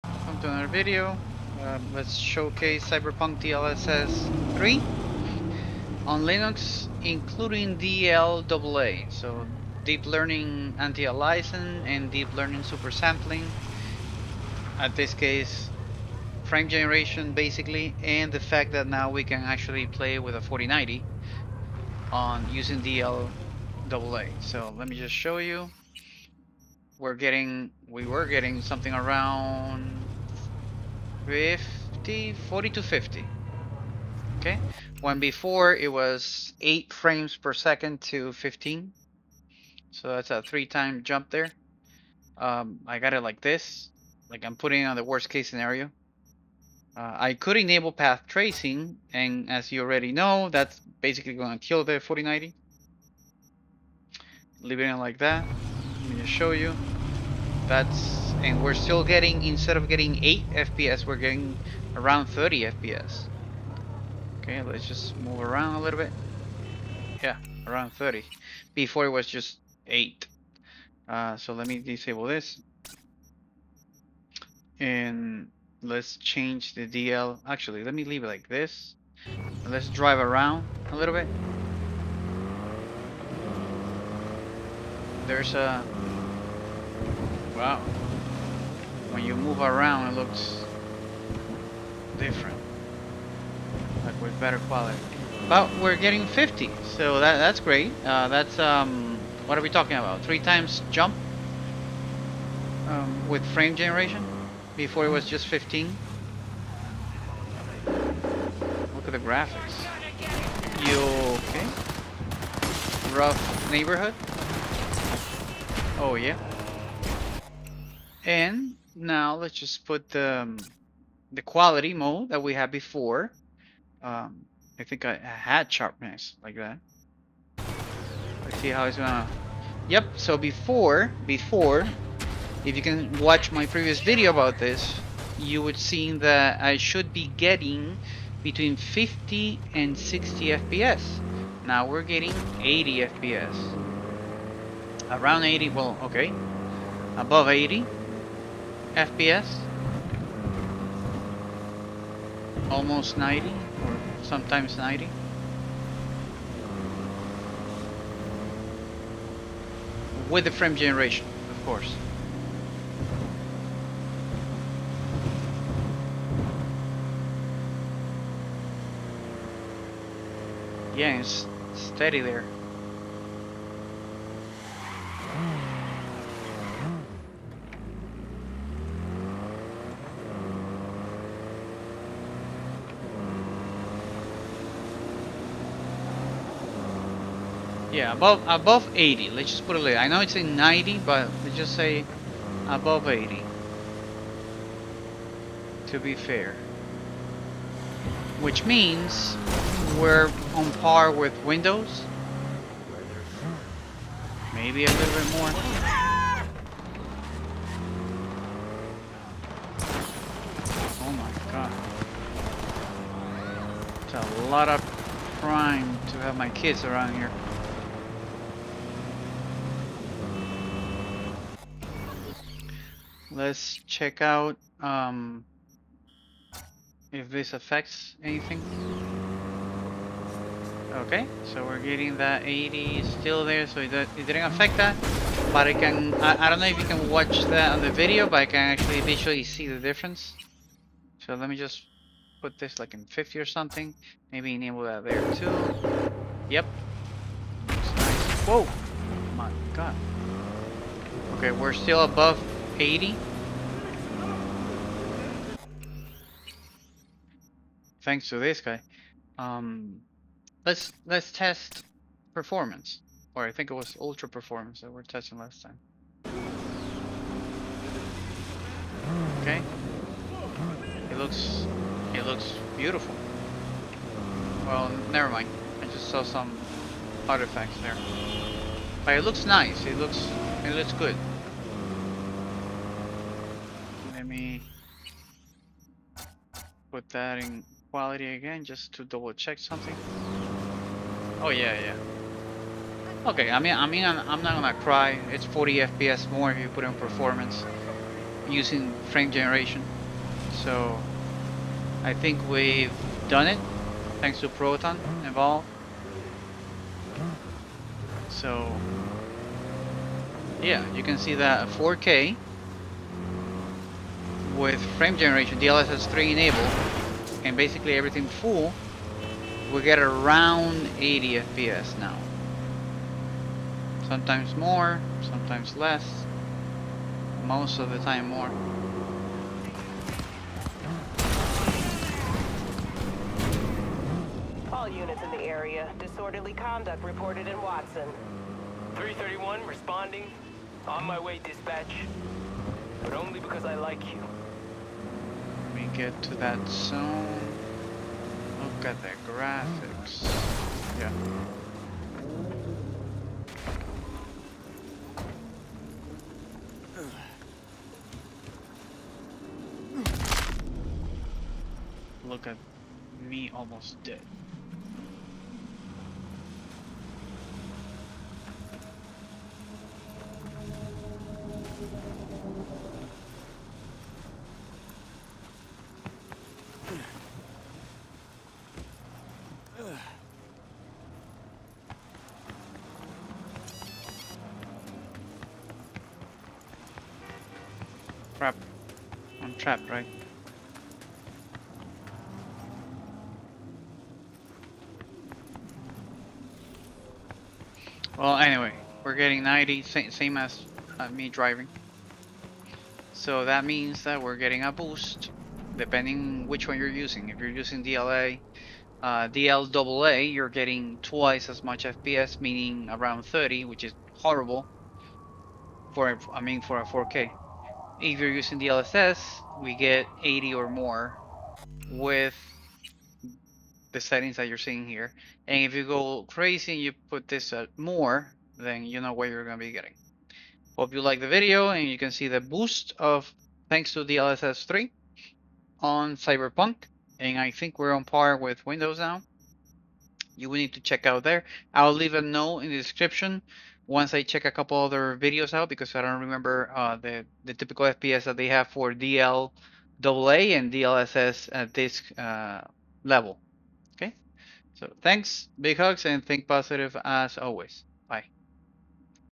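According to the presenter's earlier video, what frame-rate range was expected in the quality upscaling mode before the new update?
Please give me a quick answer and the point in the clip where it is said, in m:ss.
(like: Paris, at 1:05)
50 to 60, at 2:18.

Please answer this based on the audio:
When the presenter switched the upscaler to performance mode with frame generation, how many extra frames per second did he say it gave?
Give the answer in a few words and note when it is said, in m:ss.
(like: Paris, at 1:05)
40 FPS more, at 4:55.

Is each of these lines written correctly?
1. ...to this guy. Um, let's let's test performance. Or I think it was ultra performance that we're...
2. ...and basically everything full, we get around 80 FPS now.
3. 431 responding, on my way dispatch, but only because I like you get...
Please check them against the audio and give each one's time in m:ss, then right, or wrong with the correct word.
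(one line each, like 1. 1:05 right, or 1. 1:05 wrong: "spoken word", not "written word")
1. 4:18 right
2. 5:17 right
3. 5:38 wrong: "331", not "431".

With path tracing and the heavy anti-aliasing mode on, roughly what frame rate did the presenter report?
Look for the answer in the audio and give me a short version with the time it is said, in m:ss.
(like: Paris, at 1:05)
30 FPS, at 1:01.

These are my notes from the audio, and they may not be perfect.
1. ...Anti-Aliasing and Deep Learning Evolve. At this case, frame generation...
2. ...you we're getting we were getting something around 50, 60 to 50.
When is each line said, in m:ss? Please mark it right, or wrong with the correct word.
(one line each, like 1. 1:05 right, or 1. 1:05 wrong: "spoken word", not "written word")
1. 0:10 wrong: "Supersampling", not "Evolve"
2. 0:25 wrong: "40", not "60".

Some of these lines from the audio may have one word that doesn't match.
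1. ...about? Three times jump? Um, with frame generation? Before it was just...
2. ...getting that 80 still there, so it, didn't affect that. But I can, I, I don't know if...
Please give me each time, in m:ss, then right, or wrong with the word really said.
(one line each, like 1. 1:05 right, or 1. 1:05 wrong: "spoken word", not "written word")
1. 1:39 right
2. 3:51 right.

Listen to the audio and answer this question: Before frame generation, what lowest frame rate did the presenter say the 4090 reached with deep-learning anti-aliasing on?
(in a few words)
8 frames per second.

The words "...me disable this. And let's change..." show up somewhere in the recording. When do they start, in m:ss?
1:11.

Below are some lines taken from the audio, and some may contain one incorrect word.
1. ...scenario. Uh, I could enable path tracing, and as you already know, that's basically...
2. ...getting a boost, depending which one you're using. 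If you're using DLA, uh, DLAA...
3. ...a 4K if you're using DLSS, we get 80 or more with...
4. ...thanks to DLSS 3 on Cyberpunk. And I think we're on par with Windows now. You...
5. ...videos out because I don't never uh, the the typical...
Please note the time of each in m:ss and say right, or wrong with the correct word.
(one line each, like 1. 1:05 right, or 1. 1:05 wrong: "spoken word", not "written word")
1. 0:45 right
2. 6:44 right
3. 6:56 right
4. 7:13 right
5. 7:25 wrong: "remember", not "never".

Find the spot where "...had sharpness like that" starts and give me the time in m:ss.
2:05.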